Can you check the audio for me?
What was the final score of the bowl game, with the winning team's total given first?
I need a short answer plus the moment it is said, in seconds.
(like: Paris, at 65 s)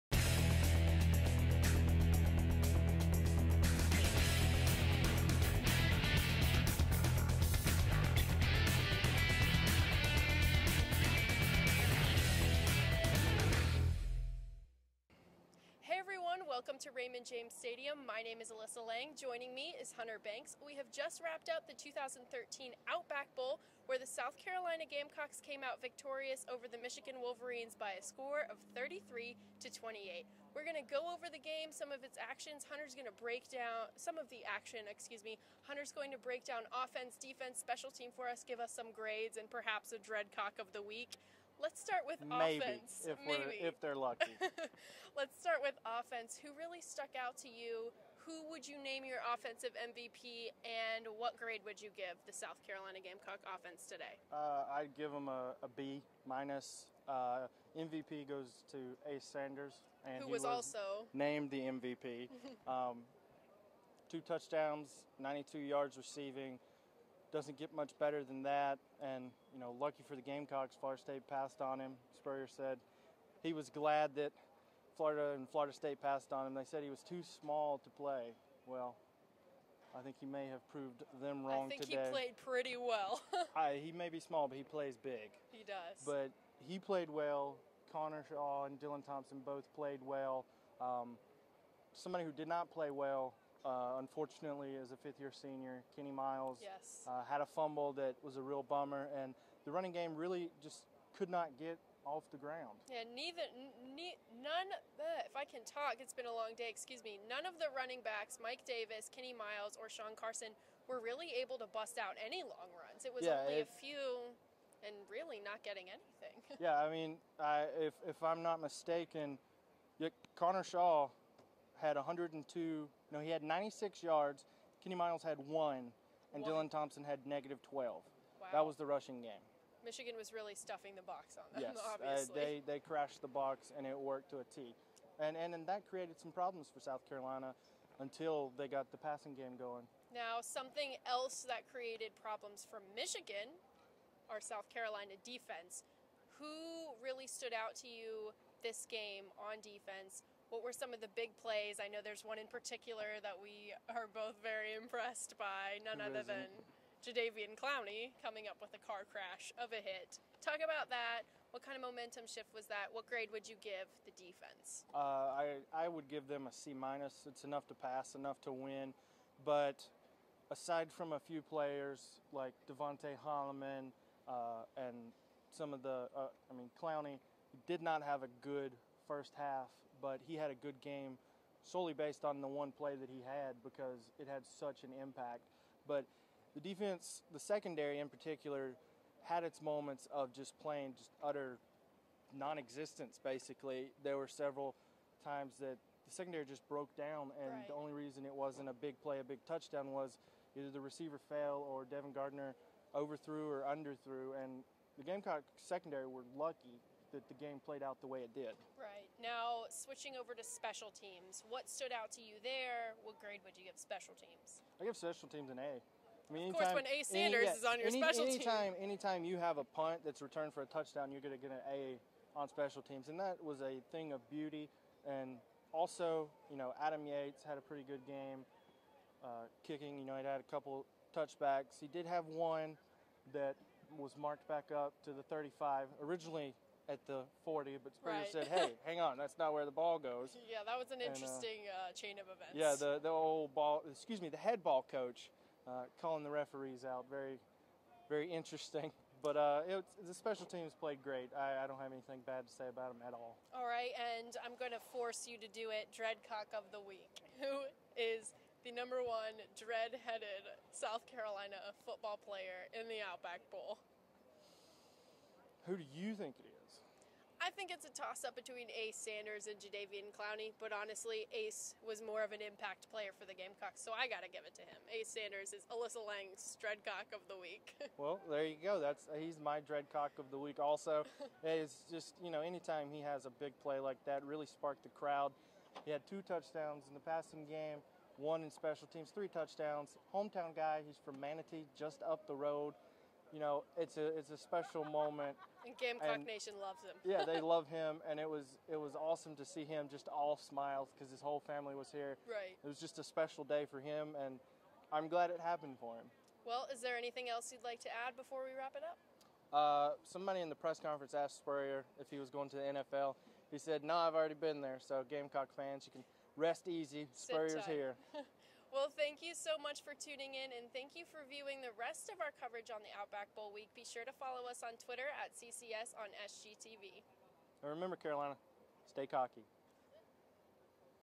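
33 to 28, at 28 s.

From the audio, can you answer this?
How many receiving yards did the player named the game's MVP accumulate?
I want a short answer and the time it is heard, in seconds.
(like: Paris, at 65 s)
92, at 65 s.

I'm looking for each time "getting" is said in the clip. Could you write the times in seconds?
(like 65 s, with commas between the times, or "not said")
115 s.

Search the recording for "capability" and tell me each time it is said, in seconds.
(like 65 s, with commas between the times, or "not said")
not said.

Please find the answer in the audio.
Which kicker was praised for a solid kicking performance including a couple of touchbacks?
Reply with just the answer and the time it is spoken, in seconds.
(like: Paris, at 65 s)
Adam Yates, at 226 s.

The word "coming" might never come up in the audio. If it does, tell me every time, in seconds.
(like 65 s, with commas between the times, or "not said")
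158 s.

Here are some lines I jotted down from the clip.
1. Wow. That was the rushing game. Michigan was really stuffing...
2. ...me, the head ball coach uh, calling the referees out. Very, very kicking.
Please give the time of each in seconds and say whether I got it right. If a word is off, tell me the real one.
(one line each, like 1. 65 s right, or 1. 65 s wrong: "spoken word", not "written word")
1. 128 s right
2. 244 s wrong: "interesting", not "kicking".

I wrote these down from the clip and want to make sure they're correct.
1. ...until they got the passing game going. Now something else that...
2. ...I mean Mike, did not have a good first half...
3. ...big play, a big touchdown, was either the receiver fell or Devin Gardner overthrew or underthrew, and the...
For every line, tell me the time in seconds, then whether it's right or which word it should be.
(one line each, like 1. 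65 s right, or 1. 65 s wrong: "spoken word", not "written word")
1. 137 s right
2. 176 s wrong: "Clowney", not "Mike"
3. 198 s right.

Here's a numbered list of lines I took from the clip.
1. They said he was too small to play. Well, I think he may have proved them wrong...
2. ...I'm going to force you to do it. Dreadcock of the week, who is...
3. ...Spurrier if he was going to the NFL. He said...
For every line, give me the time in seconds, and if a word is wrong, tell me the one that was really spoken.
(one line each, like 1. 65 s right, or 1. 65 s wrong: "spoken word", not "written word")
1. 76 s right
2. 254 s right
3. 311 s right.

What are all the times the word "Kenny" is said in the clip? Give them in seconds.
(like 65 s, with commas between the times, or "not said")
95 s, 109 s, 124 s.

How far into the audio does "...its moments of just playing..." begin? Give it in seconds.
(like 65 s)
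189 s.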